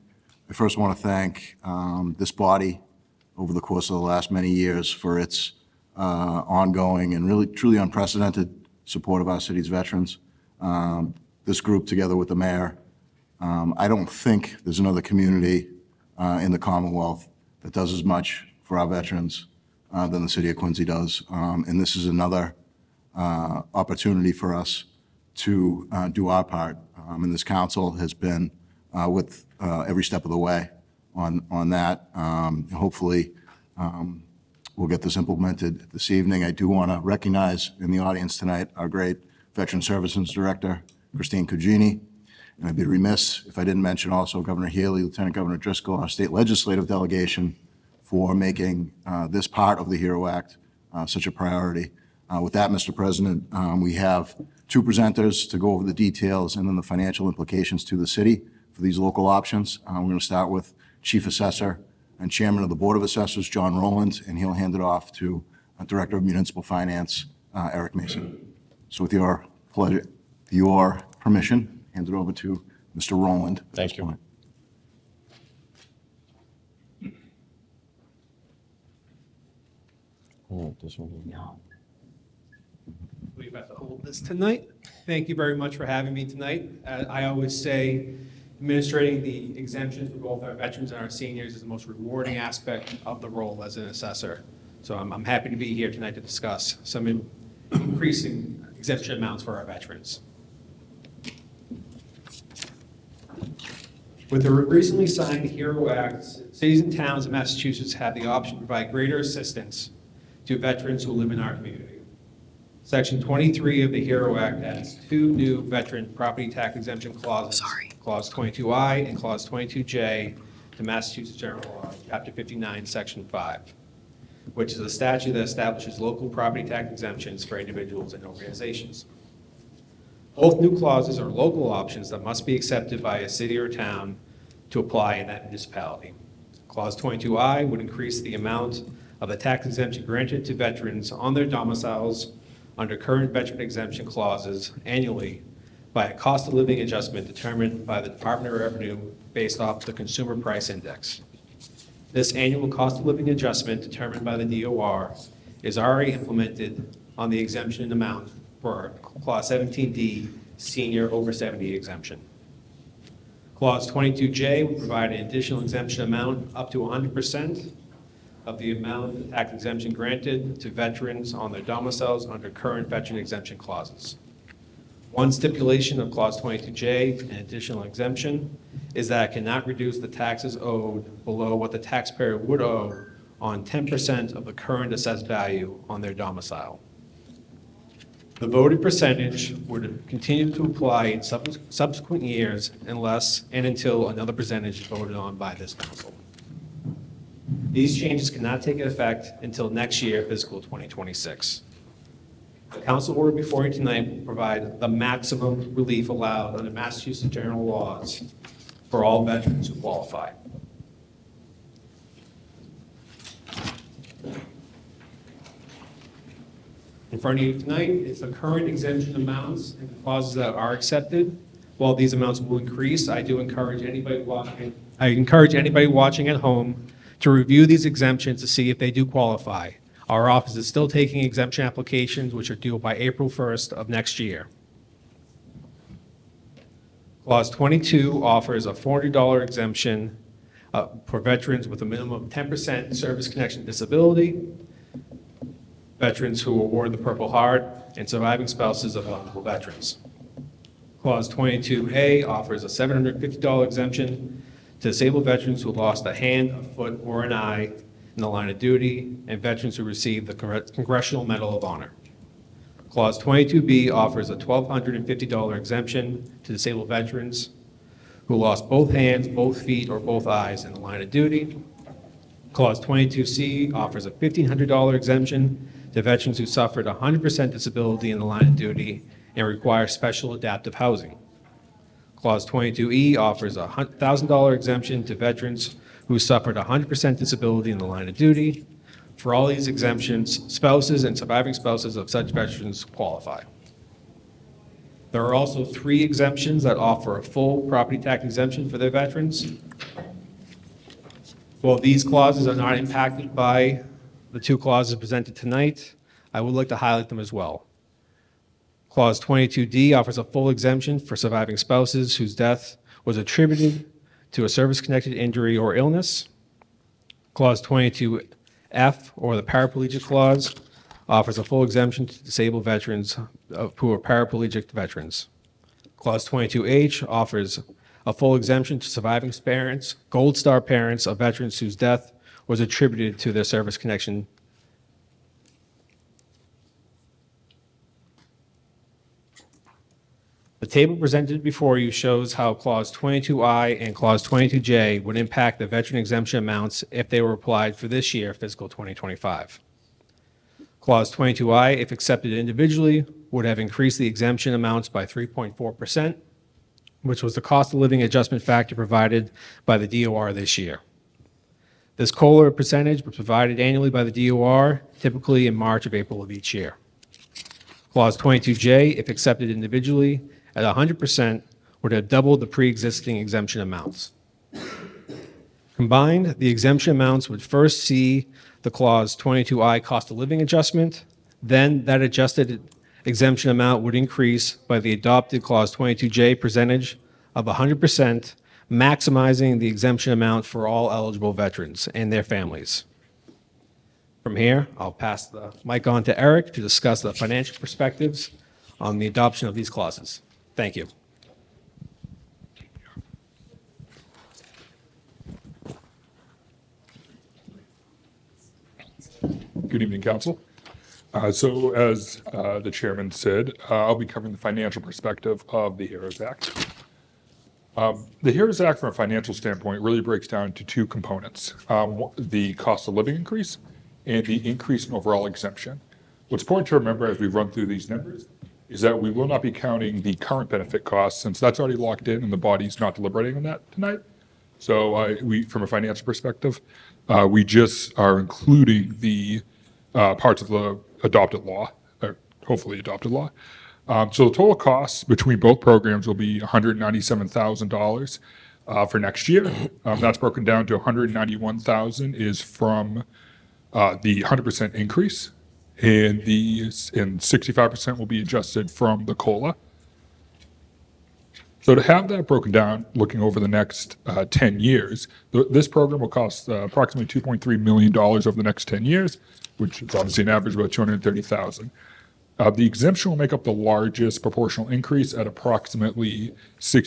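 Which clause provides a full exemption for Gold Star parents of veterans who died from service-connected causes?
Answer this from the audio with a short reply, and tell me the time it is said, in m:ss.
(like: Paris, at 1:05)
Clause 22H, at 5:25.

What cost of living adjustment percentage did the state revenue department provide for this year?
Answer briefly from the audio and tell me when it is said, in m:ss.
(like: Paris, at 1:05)
3.4%, at 5:55.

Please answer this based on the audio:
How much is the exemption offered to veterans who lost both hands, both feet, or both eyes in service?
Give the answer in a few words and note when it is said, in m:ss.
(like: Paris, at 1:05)
$1,250, at 4:24.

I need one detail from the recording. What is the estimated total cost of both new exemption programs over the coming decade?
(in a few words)
$2.3 million.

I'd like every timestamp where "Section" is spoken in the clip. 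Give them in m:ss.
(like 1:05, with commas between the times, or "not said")
1:52, 2:02.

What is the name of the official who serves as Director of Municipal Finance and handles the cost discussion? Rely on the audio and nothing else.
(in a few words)
Eric Mason.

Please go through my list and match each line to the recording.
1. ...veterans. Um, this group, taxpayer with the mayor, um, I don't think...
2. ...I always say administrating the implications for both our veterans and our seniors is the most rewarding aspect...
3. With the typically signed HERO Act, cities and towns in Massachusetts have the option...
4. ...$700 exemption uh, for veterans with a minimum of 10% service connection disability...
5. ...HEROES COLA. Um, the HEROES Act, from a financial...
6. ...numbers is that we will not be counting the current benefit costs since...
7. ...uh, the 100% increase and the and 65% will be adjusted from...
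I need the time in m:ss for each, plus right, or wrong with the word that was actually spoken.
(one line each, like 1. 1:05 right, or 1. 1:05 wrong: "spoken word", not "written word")
1. 0:09 wrong: "together", not "taxpayer"
2. 1:27 wrong: "exemptions", not "implications"
3. 1:44 wrong: "recently", not "typically"
4. 3:58 wrong: "400", not "700"
5. 6:55 wrong: "Act", not "COLA"
6. 7:07 right
7. 7:33 right.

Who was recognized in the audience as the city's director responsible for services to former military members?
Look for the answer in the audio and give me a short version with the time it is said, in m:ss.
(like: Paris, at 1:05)
Christine Cugini, at 0:41.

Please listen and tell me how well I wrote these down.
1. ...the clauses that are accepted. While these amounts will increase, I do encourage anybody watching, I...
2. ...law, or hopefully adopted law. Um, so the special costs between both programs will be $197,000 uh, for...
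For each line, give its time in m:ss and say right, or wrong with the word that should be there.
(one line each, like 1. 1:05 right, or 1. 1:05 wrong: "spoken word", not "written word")
1. 3:39 right
2. 7:21 wrong: "total", not "special".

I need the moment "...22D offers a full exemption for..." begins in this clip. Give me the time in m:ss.
5:09.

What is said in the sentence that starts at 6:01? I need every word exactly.
This COLA percentage was provided annually by the DOR, typically in March or April of each year.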